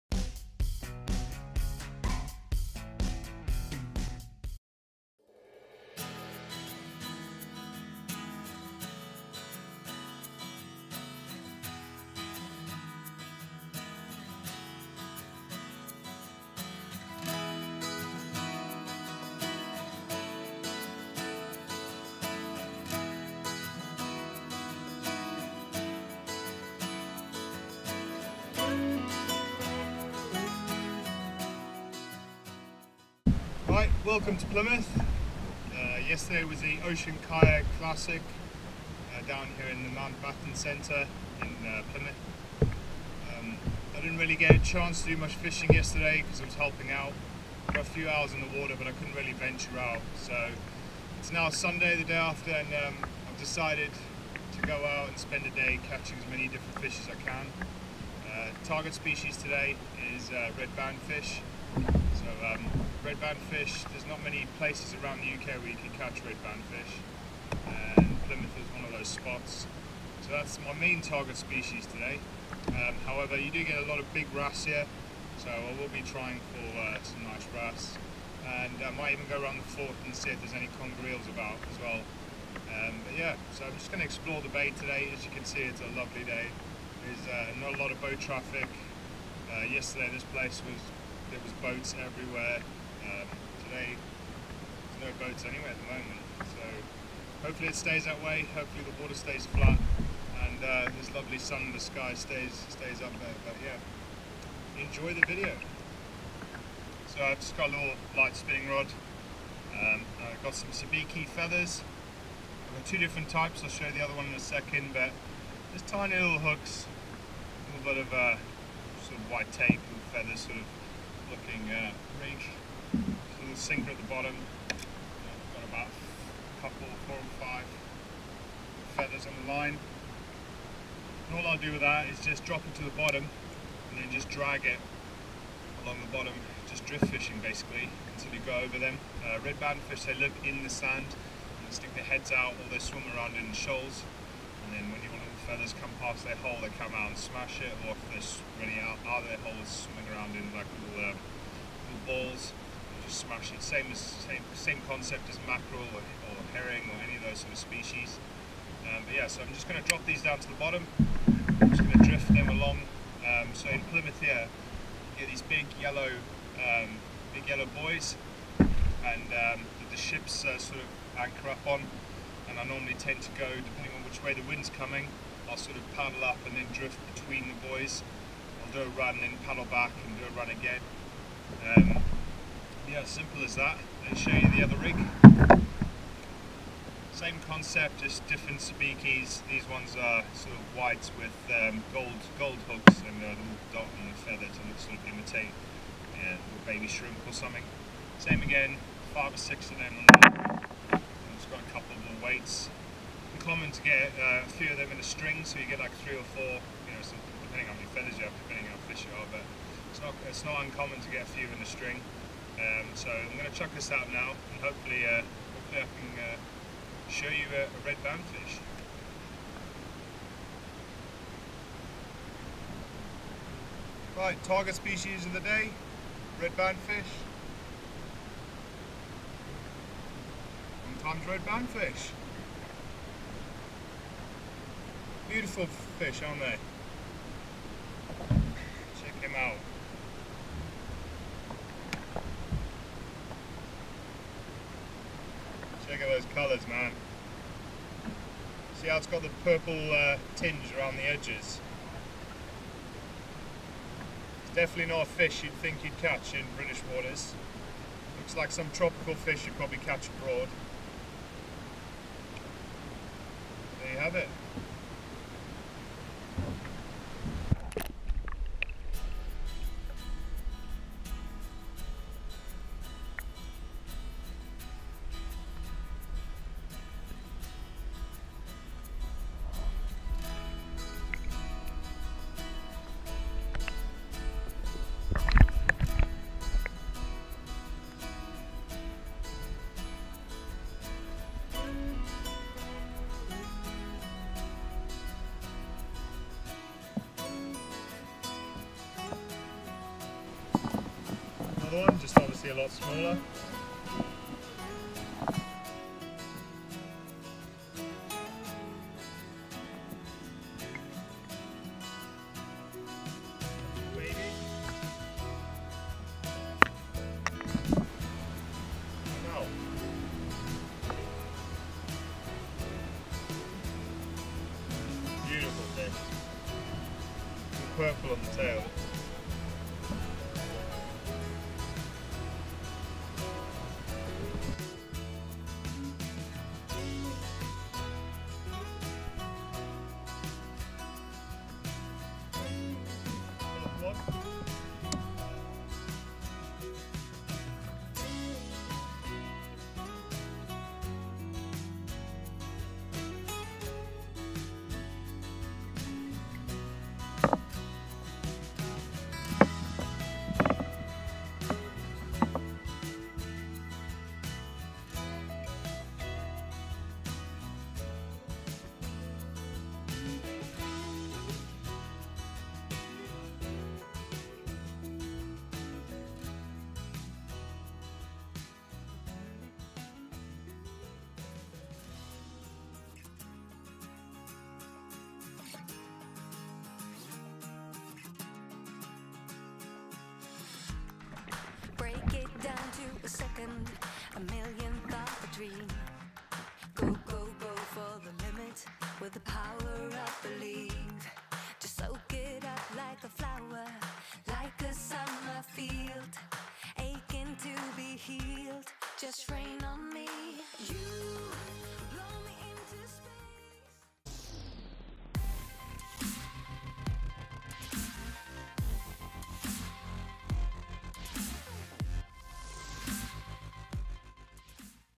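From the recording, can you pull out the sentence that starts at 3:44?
Right, target species of the day, red bandfish.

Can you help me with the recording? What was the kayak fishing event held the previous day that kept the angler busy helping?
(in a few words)
Ocean Kayak Classic.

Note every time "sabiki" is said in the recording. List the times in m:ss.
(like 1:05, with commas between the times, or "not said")
1:50, 3:08.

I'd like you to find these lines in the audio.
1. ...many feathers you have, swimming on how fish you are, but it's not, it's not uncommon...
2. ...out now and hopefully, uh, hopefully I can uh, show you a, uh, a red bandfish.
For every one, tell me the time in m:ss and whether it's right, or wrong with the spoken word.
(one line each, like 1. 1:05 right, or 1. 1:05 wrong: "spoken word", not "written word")
1. 3:27 wrong: "depending", not "swimming"
2. 3:33 right.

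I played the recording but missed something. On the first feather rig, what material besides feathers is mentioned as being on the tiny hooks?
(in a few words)
white tape.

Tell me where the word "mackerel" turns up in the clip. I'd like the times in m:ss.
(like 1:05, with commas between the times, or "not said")
2:35.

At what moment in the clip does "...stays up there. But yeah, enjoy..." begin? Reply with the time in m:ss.
1:42.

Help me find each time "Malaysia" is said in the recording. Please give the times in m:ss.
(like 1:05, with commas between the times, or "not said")
not said.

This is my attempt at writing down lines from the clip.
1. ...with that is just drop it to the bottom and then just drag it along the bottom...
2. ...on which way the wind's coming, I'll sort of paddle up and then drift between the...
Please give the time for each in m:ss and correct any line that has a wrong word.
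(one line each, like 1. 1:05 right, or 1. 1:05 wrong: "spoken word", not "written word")
1. 2:11 right
2. 2:53 right.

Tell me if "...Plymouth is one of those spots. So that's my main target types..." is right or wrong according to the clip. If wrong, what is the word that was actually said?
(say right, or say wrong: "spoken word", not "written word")
wrong: "species", not "types".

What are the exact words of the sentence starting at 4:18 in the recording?
Looks like some tropical fish you'd probably catch abroad.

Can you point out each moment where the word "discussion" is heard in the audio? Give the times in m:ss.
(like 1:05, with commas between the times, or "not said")
not said.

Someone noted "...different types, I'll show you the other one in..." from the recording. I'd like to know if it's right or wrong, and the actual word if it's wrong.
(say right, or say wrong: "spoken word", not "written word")
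right.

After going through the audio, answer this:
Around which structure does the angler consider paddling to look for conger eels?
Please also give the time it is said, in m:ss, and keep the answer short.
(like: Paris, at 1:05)
the fort, at 1:19.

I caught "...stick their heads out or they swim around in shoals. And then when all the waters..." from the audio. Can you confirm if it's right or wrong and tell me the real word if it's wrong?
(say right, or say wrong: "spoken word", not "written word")
wrong: "feathers", not "waters".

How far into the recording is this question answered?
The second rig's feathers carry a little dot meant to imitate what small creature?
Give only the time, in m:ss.
3:16.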